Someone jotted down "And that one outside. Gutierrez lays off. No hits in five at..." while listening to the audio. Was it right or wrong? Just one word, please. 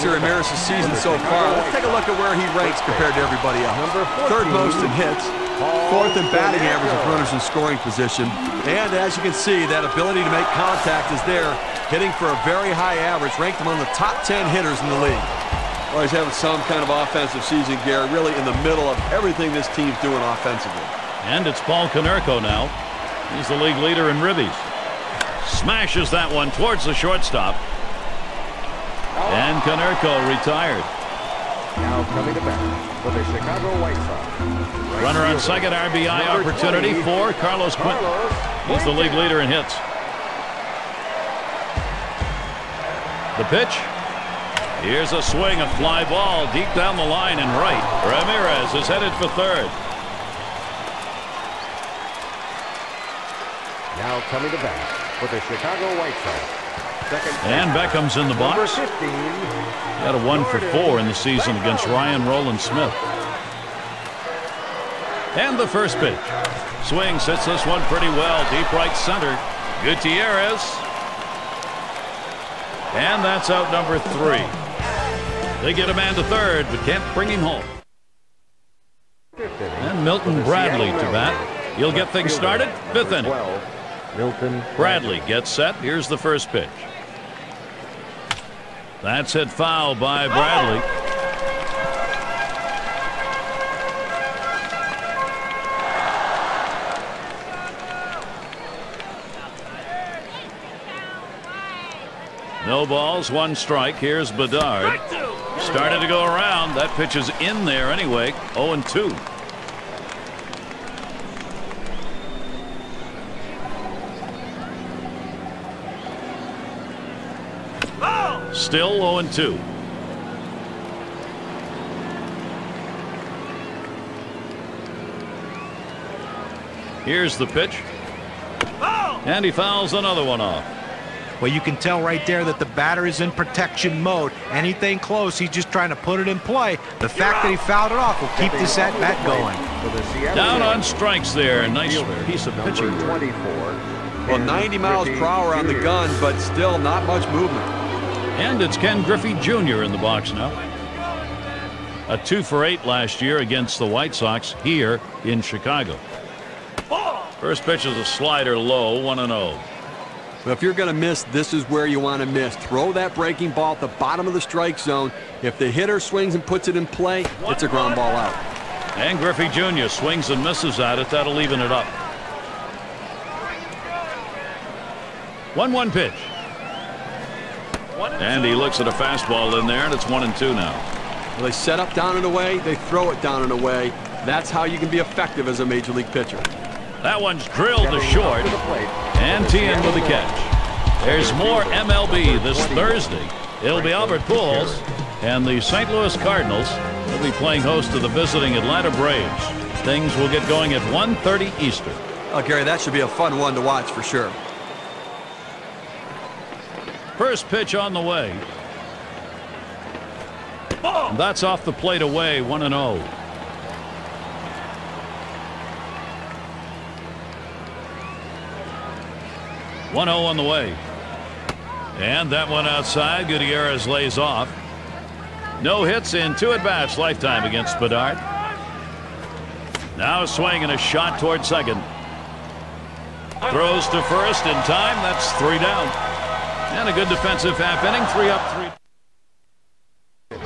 wrong.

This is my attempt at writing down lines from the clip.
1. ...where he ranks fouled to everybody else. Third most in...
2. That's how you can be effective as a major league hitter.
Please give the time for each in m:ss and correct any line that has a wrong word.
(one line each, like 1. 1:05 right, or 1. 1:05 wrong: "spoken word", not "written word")
1. 0:02 wrong: "compared", not "fouled"
2. 3:04 wrong: "pitcher", not "hitter".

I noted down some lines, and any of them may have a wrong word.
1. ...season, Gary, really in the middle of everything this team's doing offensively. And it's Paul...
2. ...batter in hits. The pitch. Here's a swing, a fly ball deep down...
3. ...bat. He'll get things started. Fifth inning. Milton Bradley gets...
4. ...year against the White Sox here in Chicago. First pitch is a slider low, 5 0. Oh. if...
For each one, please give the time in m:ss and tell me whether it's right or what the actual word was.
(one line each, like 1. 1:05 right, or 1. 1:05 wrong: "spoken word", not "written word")
1. 0:17 right
2. 0:39 wrong: "leader", not "batter"
3. 1:21 right
4. 2:33 wrong: "1", not "5".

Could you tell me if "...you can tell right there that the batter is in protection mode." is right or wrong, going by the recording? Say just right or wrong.
right.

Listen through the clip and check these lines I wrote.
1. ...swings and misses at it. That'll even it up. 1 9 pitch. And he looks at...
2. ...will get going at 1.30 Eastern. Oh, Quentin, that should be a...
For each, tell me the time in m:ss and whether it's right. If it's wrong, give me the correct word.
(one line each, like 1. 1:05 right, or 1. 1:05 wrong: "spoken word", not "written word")
1. 2:49 wrong: "1", not "9"
2. 3:20 wrong: "Gary", not "Quentin".